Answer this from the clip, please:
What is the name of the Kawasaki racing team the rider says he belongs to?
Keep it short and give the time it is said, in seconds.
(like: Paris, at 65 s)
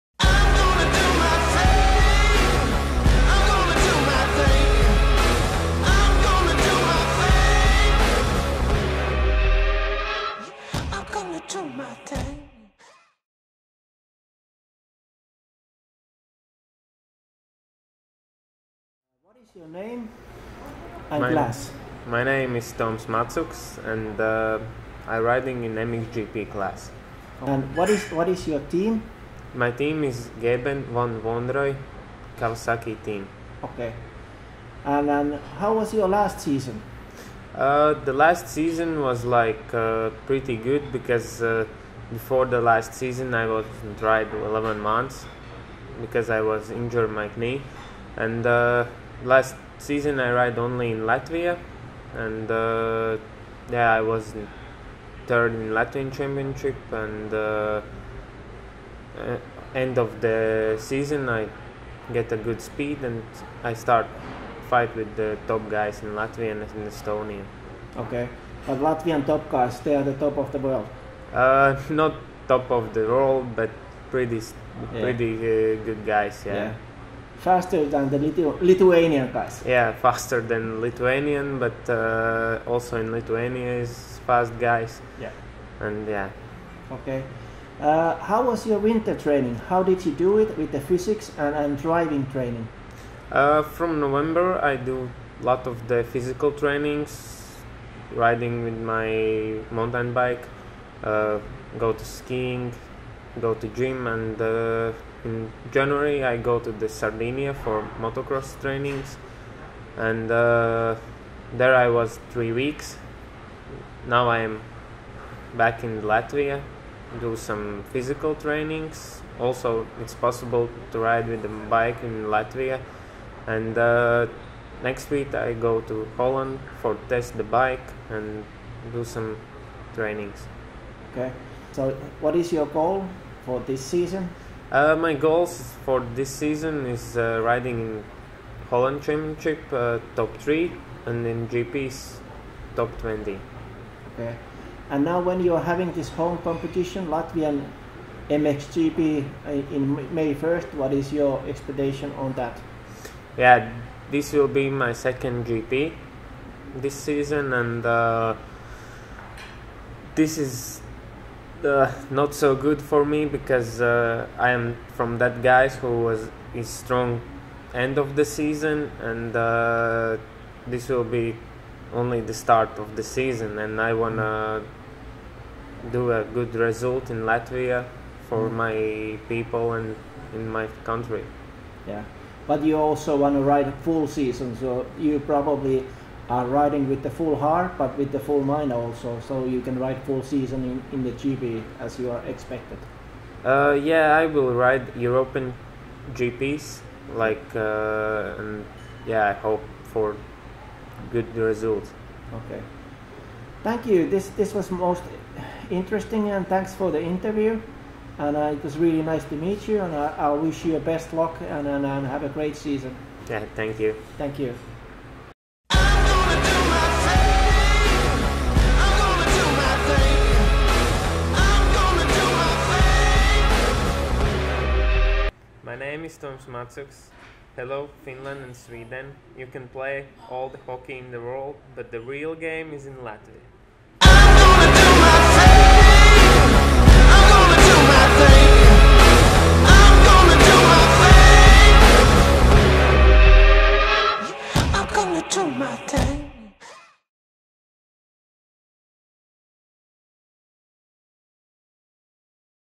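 Gebben Van Venrooy Kawasaki, at 30 s.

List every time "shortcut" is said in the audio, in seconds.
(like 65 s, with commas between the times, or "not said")
not said.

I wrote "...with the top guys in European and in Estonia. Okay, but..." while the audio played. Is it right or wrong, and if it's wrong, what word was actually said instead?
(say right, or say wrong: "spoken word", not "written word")
wrong: "Latvia", not "European".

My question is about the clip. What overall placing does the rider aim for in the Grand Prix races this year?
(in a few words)
Top 20.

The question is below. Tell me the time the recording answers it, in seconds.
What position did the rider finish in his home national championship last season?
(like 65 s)
55 s.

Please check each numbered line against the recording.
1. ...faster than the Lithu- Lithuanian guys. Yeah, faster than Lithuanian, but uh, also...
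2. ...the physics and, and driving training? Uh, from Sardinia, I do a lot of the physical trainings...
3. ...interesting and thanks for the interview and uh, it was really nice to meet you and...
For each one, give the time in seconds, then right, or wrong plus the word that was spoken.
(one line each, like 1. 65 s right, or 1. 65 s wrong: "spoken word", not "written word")
1. 77 s right
2. 90 s wrong: "November", not "Sardinia"
3. 205 s right.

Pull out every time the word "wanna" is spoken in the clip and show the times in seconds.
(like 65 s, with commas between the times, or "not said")
173 s, 183 s.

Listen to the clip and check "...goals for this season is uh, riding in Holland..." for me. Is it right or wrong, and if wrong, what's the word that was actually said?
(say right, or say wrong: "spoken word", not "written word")
right.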